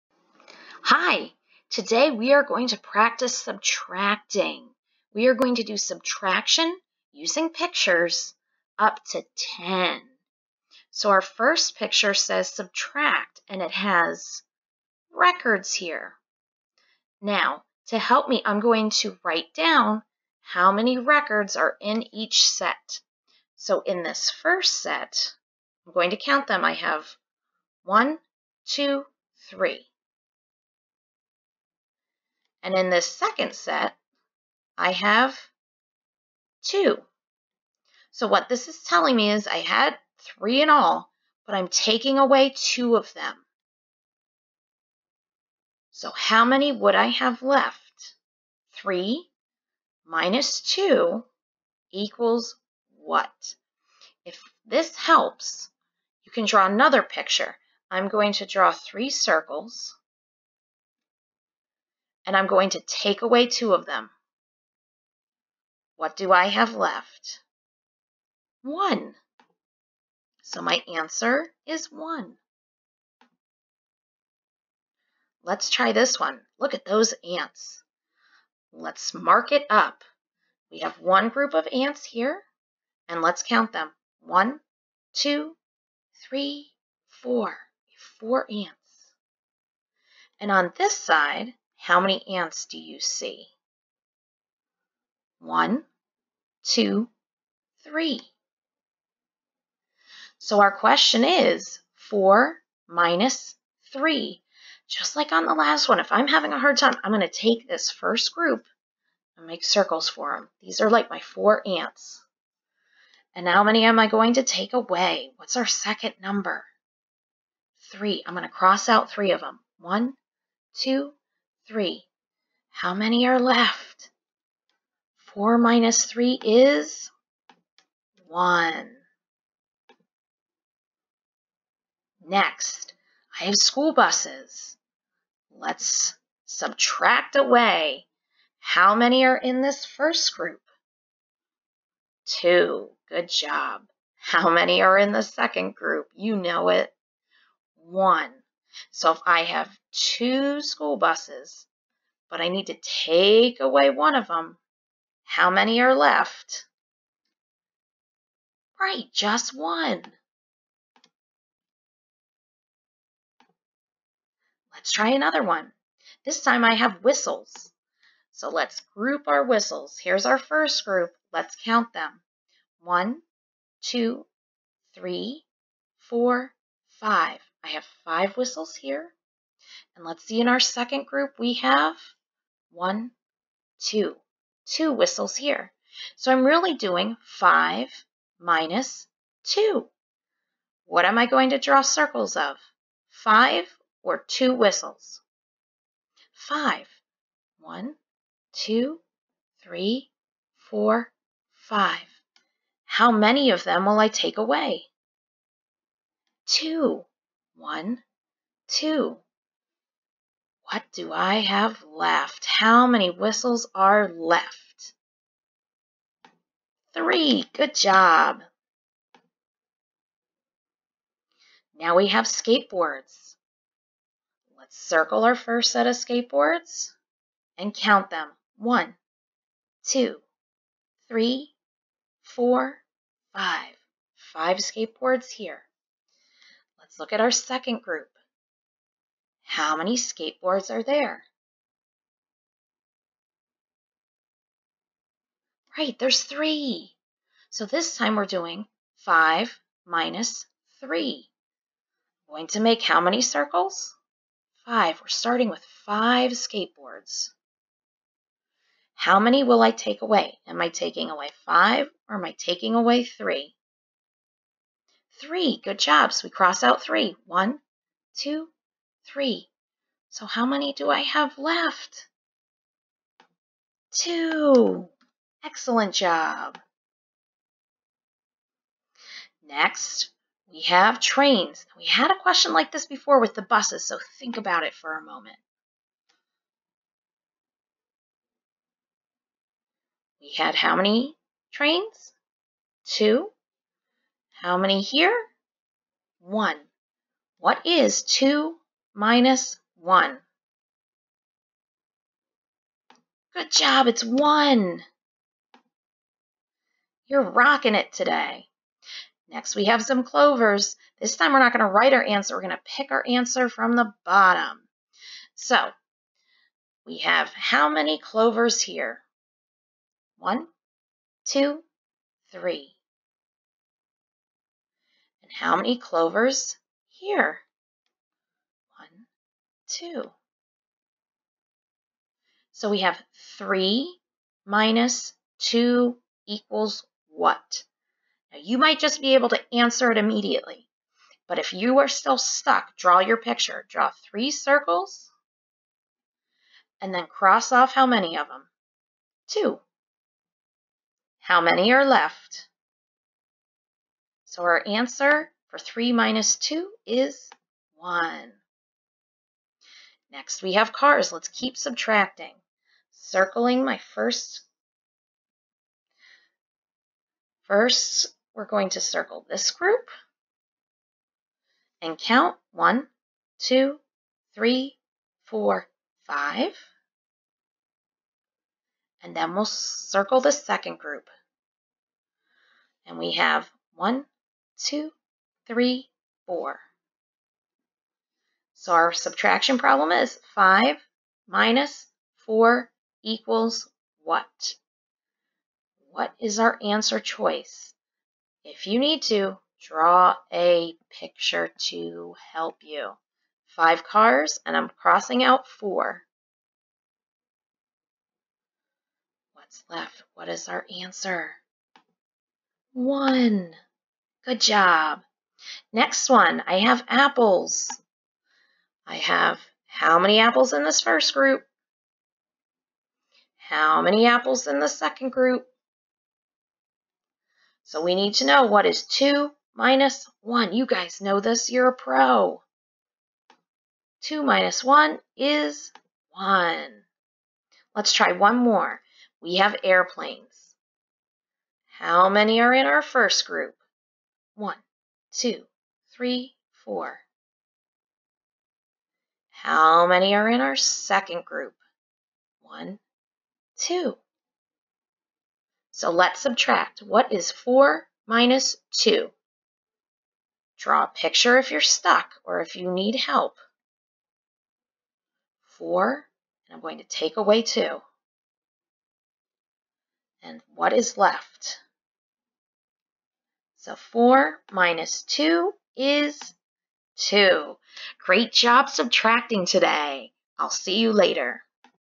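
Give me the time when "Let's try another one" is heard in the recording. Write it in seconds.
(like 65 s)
164 s.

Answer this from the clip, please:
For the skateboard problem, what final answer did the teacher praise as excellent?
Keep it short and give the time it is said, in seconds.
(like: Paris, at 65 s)
2, at 273 s.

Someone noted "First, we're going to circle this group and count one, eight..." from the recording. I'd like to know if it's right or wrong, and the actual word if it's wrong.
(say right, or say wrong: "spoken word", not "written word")
wrong: "two", not "eight".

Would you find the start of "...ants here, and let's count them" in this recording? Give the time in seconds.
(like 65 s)
81 s.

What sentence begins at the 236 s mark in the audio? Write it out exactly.
Let's look at our second group.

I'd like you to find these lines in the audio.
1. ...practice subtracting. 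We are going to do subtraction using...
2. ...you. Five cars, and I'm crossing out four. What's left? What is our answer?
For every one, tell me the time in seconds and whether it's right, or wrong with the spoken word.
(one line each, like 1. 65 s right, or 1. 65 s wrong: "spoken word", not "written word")
1. 2 s right
2. 402 s right.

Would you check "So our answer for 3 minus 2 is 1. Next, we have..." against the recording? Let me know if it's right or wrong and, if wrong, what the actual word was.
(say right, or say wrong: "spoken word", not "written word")
right.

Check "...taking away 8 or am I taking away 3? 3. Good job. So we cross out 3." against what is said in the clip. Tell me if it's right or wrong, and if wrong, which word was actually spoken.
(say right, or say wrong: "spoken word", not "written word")
wrong: "5", not "8".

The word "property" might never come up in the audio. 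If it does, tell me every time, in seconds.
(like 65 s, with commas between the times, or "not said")
not said.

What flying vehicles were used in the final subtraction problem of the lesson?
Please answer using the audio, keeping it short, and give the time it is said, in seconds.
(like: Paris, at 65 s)
Airplanes, at 439 s.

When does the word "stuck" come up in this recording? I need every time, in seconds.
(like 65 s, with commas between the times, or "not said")
342 s, 461 s.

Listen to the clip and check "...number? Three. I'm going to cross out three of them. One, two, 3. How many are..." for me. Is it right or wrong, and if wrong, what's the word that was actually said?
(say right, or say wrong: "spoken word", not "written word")
right.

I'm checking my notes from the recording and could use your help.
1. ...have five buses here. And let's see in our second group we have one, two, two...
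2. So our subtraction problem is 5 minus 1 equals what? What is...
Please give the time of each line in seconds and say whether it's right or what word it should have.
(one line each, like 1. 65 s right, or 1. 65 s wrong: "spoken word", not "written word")
1. 177 s wrong: "whistles", not "buses"
2. 388 s wrong: "4", not "1".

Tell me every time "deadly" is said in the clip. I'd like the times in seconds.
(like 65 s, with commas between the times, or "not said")
not said.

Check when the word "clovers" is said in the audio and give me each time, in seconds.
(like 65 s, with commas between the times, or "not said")
310 s, 317 s, 325 s.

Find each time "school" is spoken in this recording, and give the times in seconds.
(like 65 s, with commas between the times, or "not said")
133 s, 150 s.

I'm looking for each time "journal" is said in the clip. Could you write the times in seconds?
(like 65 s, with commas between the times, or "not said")
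not said.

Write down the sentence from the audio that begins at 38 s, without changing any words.
So what this is telling me is I had three in all, but I'm taking away two of them.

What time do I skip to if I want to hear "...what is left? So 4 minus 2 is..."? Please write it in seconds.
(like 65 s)
470 s.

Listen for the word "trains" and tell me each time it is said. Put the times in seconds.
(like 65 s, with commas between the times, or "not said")
280 s, 291 s.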